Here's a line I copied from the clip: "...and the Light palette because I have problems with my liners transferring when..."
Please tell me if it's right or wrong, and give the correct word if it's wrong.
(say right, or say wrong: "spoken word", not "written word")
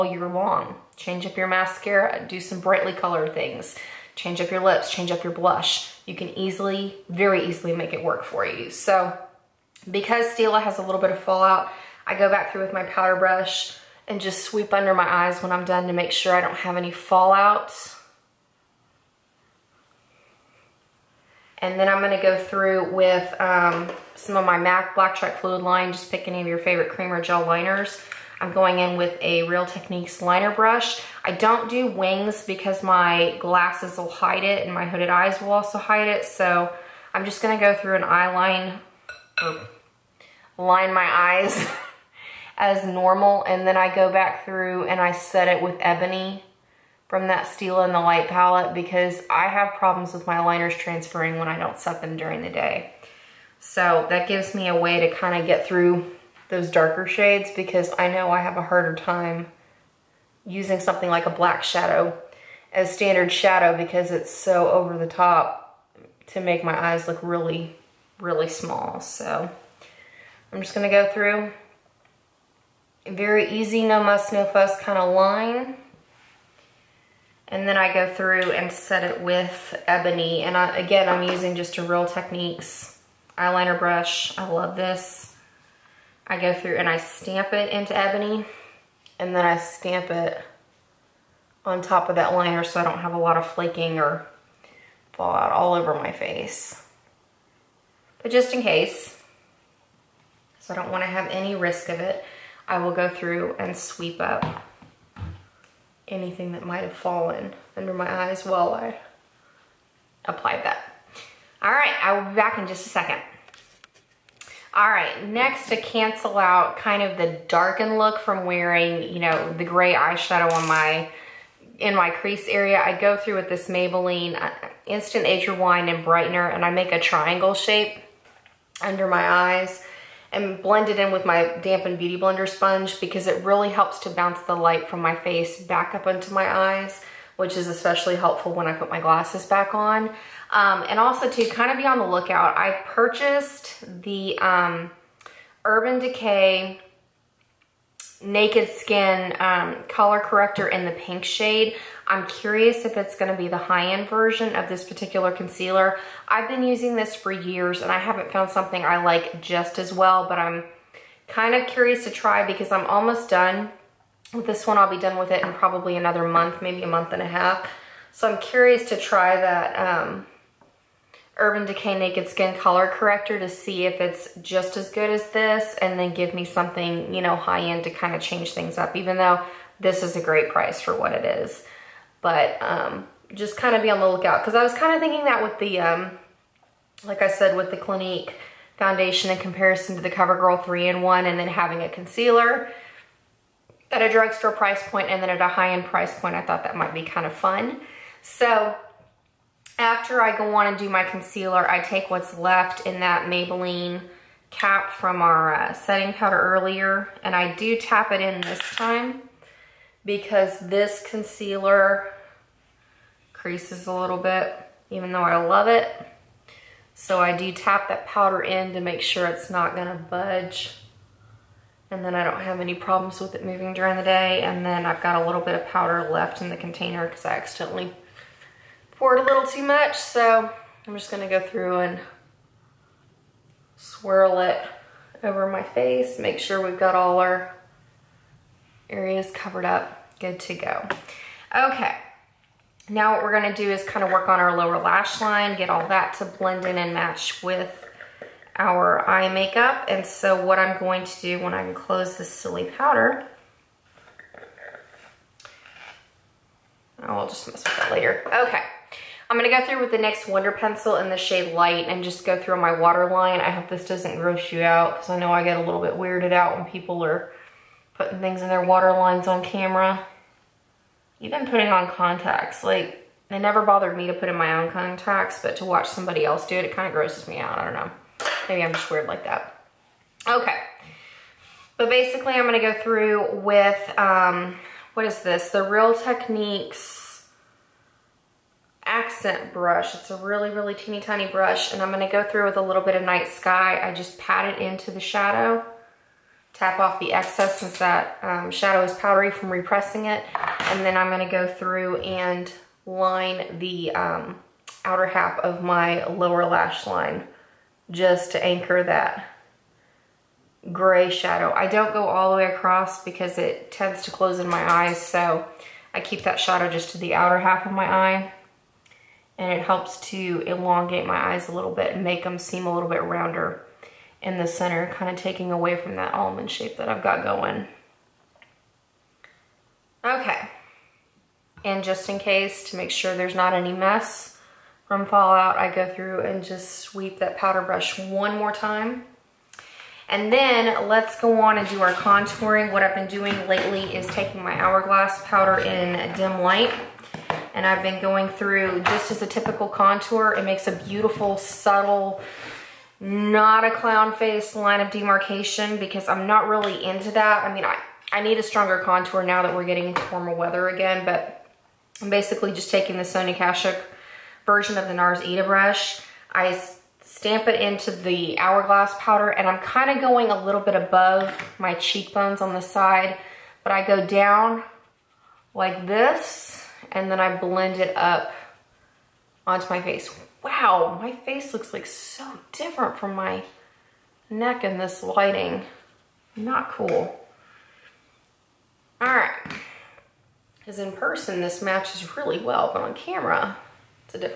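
right.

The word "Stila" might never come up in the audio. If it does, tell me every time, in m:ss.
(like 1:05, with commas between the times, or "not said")
0:10, 0:47.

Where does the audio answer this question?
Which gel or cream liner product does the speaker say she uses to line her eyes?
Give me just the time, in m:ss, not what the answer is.
0:24.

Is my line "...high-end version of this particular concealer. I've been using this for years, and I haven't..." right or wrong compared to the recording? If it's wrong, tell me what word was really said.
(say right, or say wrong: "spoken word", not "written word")
right.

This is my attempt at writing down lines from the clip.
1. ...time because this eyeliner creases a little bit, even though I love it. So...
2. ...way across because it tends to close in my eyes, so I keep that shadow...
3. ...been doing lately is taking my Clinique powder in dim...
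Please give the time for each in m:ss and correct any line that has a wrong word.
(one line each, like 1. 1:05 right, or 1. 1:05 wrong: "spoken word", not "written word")
1. 3:28 wrong: "concealer", not "eyeliner"
2. 5:12 right
3. 5:42 wrong: "Hourglass", not "Clinique".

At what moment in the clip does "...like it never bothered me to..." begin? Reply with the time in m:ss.
4:32.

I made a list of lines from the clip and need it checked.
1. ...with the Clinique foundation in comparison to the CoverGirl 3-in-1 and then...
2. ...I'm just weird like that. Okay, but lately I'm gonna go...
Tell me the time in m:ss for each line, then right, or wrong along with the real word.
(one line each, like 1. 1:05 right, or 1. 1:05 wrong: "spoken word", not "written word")
1. 3:07 right
2. 4:38 wrong: "basically", not "lately".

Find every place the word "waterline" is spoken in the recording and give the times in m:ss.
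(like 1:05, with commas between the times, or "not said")
4:22, 4:28.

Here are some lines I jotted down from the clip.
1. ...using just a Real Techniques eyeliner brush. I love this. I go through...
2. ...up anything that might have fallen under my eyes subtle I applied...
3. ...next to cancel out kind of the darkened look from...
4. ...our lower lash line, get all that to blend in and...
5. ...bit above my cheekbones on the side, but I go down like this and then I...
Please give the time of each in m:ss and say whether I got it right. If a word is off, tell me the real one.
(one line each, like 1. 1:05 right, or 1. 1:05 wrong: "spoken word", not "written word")
1. 1:21 right
2. 1:44 wrong: "while", not "subtle"
3. 1:55 right
4. 4:04 right
5. 6:10 right.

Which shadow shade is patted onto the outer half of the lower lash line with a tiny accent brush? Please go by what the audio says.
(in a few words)
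night sky.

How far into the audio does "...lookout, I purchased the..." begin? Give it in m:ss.
2:22.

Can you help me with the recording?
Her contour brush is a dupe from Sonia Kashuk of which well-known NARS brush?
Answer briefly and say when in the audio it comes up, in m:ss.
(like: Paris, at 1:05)
Ita brush, at 6:04.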